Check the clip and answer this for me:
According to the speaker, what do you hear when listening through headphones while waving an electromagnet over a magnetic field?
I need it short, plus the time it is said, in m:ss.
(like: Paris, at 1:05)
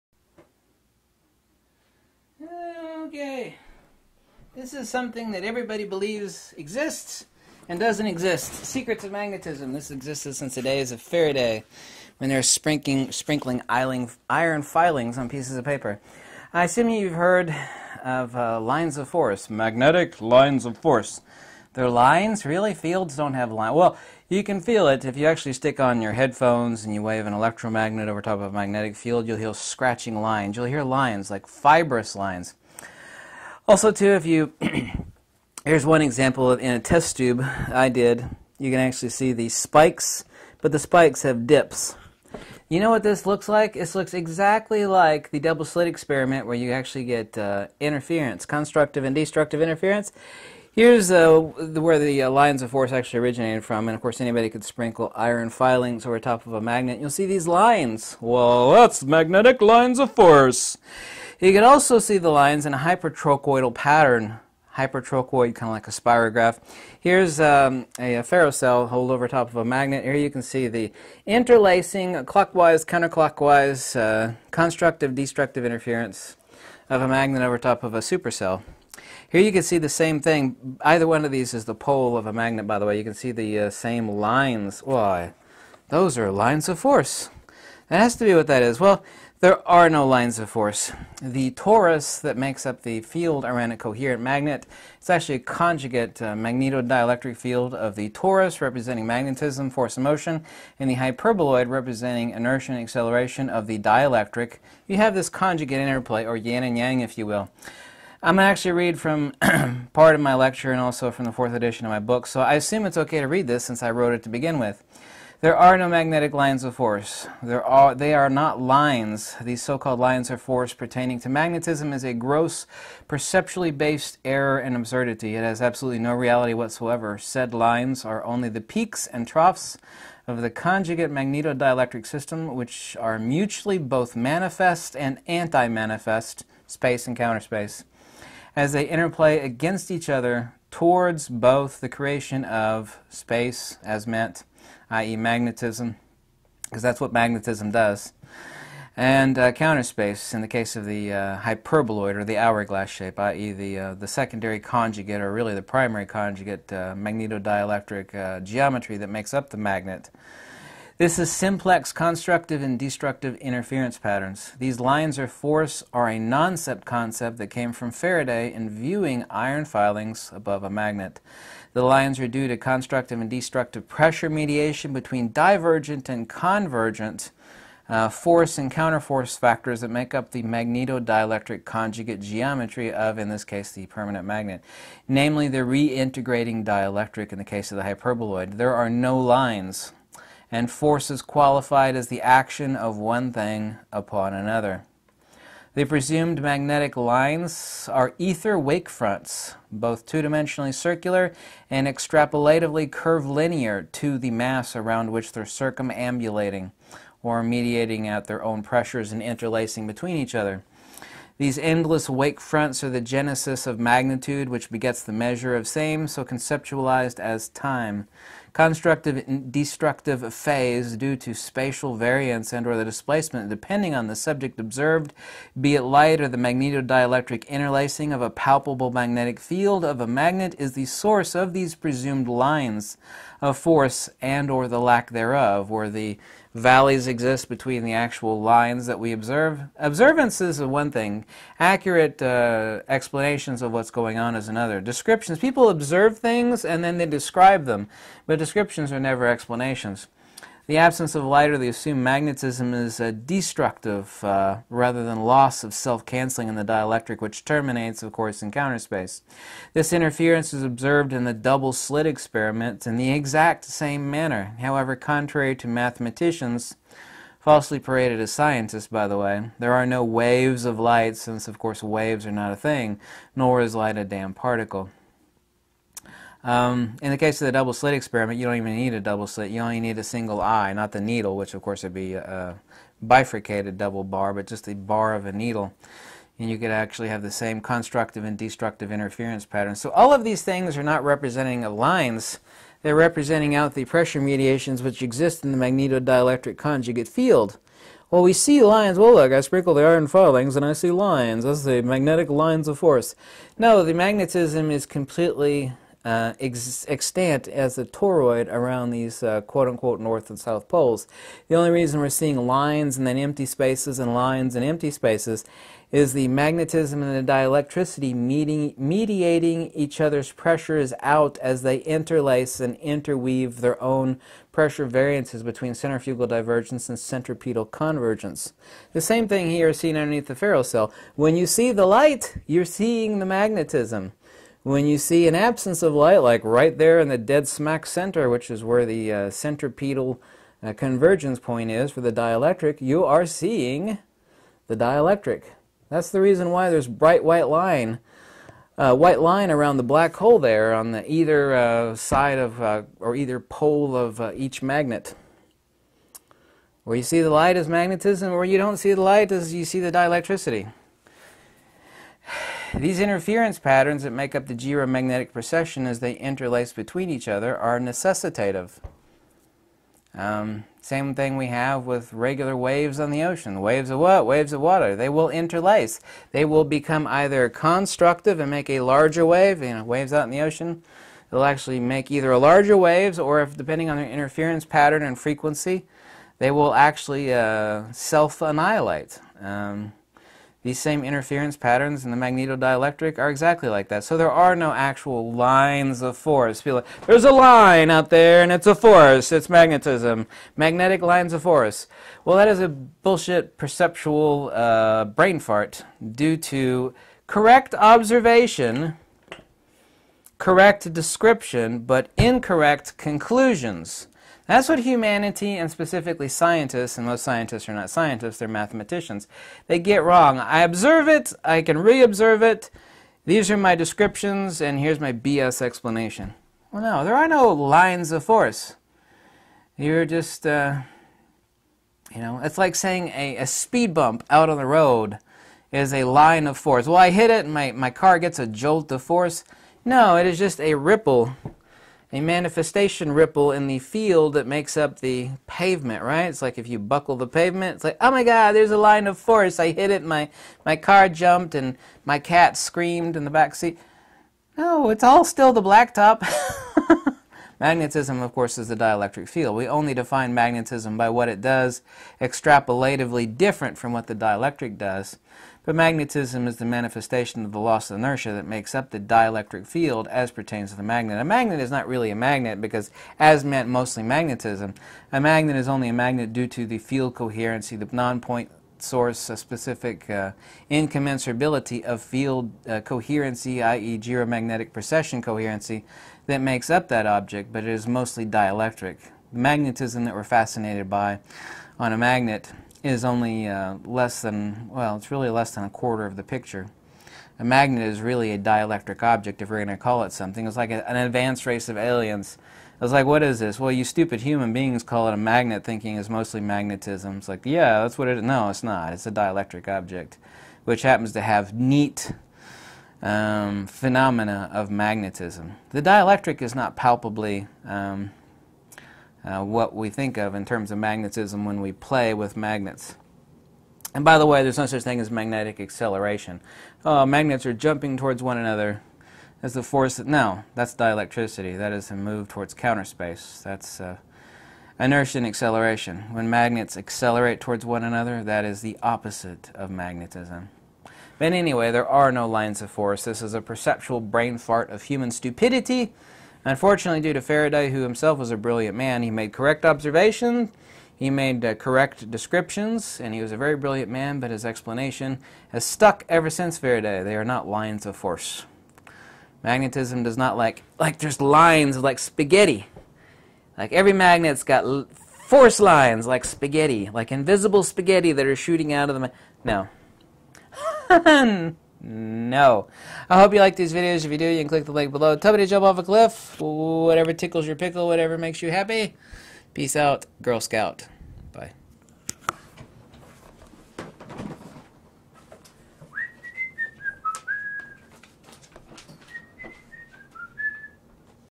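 scratching lines, at 0:29.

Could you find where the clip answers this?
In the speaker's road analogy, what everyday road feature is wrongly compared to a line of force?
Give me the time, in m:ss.
7:13.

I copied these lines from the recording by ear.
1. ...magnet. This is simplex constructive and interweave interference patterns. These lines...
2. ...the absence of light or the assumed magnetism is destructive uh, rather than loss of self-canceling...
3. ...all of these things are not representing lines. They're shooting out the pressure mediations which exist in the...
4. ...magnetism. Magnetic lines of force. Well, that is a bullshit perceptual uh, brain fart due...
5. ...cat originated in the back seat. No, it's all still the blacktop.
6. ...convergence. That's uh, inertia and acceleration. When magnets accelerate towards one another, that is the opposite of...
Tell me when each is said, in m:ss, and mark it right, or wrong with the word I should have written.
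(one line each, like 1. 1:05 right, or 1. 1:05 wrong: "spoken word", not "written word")
1. 2:39 wrong: "destructive", not "interweave"
2. 4:10 right
3. 4:49 wrong: "representing", not "shooting"
4. 6:39 right
5. 7:32 wrong: "screamed", not "originated"
6. 8:52 wrong: "space", not "convergence".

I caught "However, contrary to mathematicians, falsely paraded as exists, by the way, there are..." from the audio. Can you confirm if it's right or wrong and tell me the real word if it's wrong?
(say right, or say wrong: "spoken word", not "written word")
wrong: "scientists", not "exists".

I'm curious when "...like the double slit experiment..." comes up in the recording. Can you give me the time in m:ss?
0:44.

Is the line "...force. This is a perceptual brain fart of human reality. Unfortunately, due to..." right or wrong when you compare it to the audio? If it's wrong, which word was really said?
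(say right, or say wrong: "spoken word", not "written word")
wrong: "stupidity", not "reality".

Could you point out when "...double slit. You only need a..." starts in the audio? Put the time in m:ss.
4:38.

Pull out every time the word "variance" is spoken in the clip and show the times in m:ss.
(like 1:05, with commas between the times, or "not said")
3:41, 5:24.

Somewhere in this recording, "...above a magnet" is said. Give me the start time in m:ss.
2:50.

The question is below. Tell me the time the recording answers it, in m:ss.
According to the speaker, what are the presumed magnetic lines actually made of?
3:18.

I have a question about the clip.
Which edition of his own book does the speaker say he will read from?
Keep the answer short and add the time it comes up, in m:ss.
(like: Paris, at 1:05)
fourth edition, at 1:51.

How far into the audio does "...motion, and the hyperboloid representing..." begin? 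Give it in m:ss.
1:40.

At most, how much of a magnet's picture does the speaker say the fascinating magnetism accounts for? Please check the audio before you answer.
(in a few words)
less than a quarter.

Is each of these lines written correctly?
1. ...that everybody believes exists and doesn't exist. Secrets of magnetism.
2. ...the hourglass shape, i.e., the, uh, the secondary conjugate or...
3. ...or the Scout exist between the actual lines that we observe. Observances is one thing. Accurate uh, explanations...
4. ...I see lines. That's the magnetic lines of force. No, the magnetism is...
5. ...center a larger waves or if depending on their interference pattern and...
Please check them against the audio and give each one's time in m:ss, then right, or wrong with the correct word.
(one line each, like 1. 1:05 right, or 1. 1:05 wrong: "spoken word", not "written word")
1. 0:05 right
2. 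2:32 right
3. 3:55 wrong: "Valleys", not "Scout"
4. 5:00 right
5. 6:22 wrong: "either", not "center".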